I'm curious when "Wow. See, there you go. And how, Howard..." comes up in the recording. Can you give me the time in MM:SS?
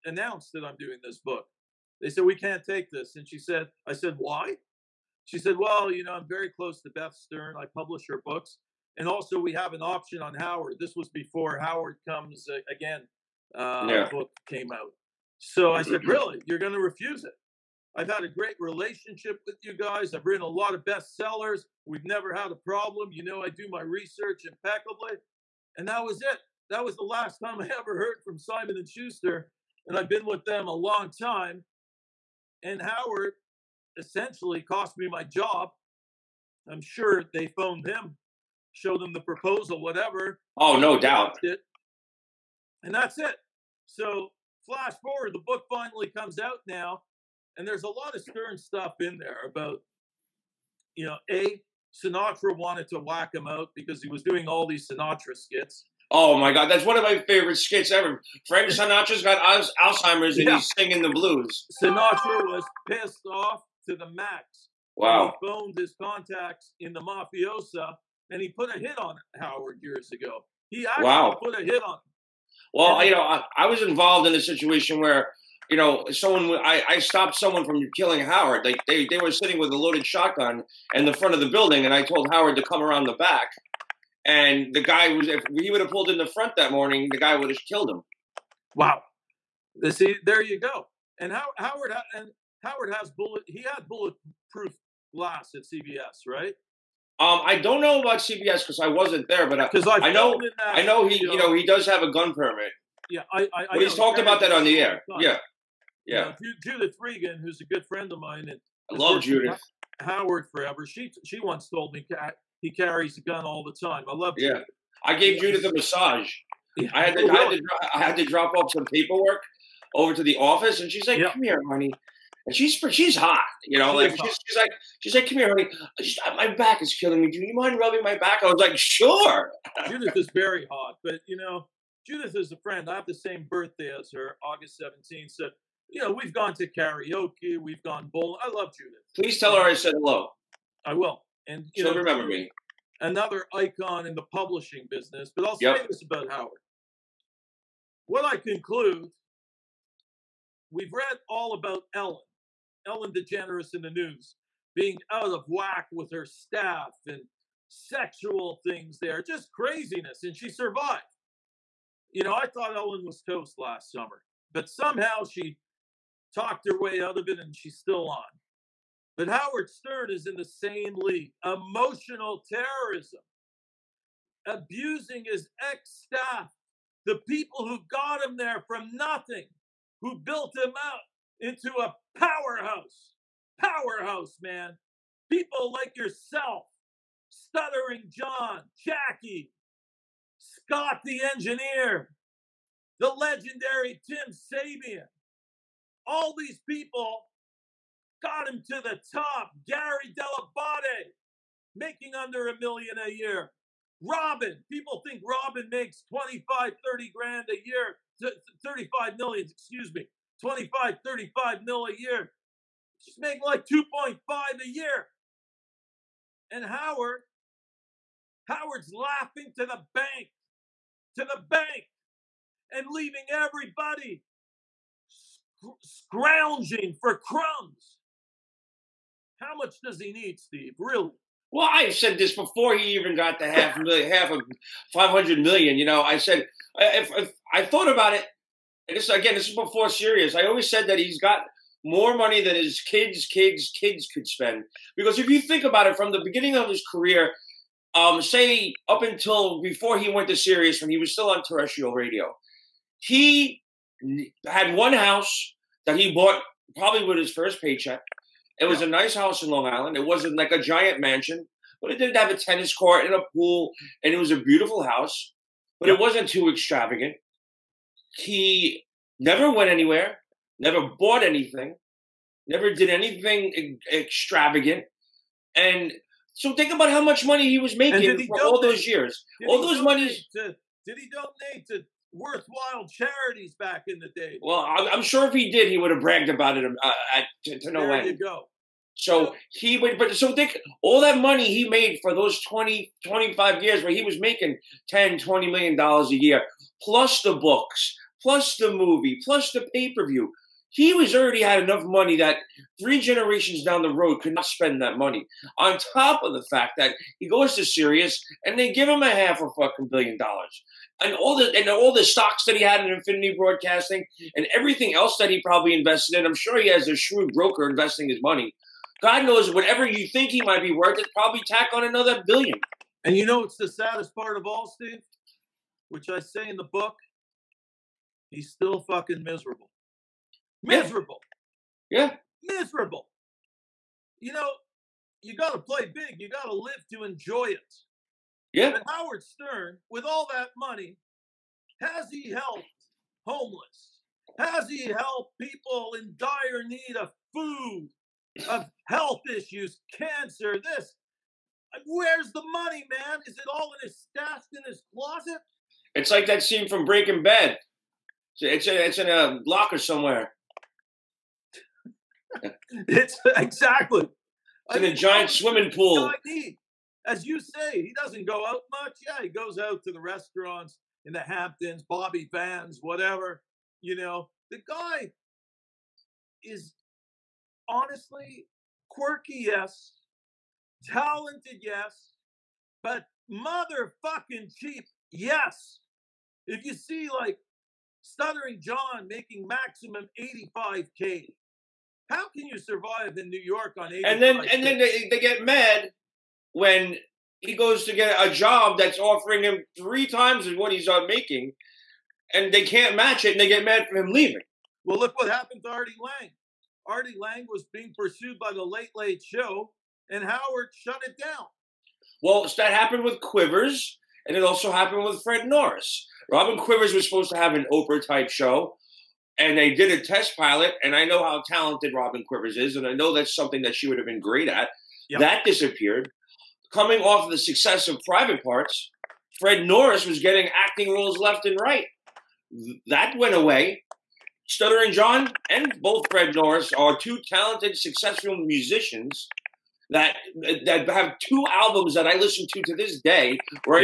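01:28.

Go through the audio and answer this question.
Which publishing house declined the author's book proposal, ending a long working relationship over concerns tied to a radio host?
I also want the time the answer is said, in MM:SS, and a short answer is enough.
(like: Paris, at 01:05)
Simon and Schuster, at 00:28.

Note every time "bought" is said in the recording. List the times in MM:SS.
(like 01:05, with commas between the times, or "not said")
04:16, 04:30.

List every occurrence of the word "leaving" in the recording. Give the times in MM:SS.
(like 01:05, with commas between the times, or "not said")
03:42, 06:44.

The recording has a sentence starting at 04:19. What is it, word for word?
It wasn't like a giant mansion, but it did have a tennis court and a pool, and it was a beautiful house.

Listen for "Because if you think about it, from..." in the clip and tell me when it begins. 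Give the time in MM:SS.
04:04.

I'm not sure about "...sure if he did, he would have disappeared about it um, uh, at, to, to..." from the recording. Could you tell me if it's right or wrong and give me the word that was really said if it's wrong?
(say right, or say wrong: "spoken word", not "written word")
wrong: "bragged", not "disappeared".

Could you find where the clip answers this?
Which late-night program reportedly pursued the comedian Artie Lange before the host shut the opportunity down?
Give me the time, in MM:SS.
06:48.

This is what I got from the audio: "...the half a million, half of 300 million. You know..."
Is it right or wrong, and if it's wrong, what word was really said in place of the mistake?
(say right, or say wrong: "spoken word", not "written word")
wrong: "500", not "300".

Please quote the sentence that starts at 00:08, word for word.
And also, we have an option on Howard.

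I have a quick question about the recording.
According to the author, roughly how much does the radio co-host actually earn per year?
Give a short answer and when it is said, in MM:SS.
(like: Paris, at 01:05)
2.5 million, at 03:33.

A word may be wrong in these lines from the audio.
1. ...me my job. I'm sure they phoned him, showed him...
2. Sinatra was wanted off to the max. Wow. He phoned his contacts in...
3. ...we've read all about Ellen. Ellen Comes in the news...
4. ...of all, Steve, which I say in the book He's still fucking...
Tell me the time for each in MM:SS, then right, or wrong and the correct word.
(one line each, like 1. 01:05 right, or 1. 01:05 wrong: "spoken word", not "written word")
1. 00:34 right
2. 01:01 wrong: "pissed", not "wanted"
3. 02:30 wrong: "DeGeneres", not "Comes"
4. 05:24 right.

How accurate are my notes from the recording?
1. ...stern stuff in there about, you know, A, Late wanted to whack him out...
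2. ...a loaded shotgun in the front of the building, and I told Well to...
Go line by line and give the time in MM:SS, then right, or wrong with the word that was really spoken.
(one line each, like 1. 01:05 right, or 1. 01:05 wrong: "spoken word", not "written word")
1. 00:48 wrong: "Sinatra", not "Late"
2. 01:19 wrong: "Howard", not "Well".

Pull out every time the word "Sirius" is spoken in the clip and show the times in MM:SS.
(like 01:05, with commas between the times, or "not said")
03:59, 04:10, 05:07.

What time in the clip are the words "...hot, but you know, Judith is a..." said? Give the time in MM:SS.
02:10.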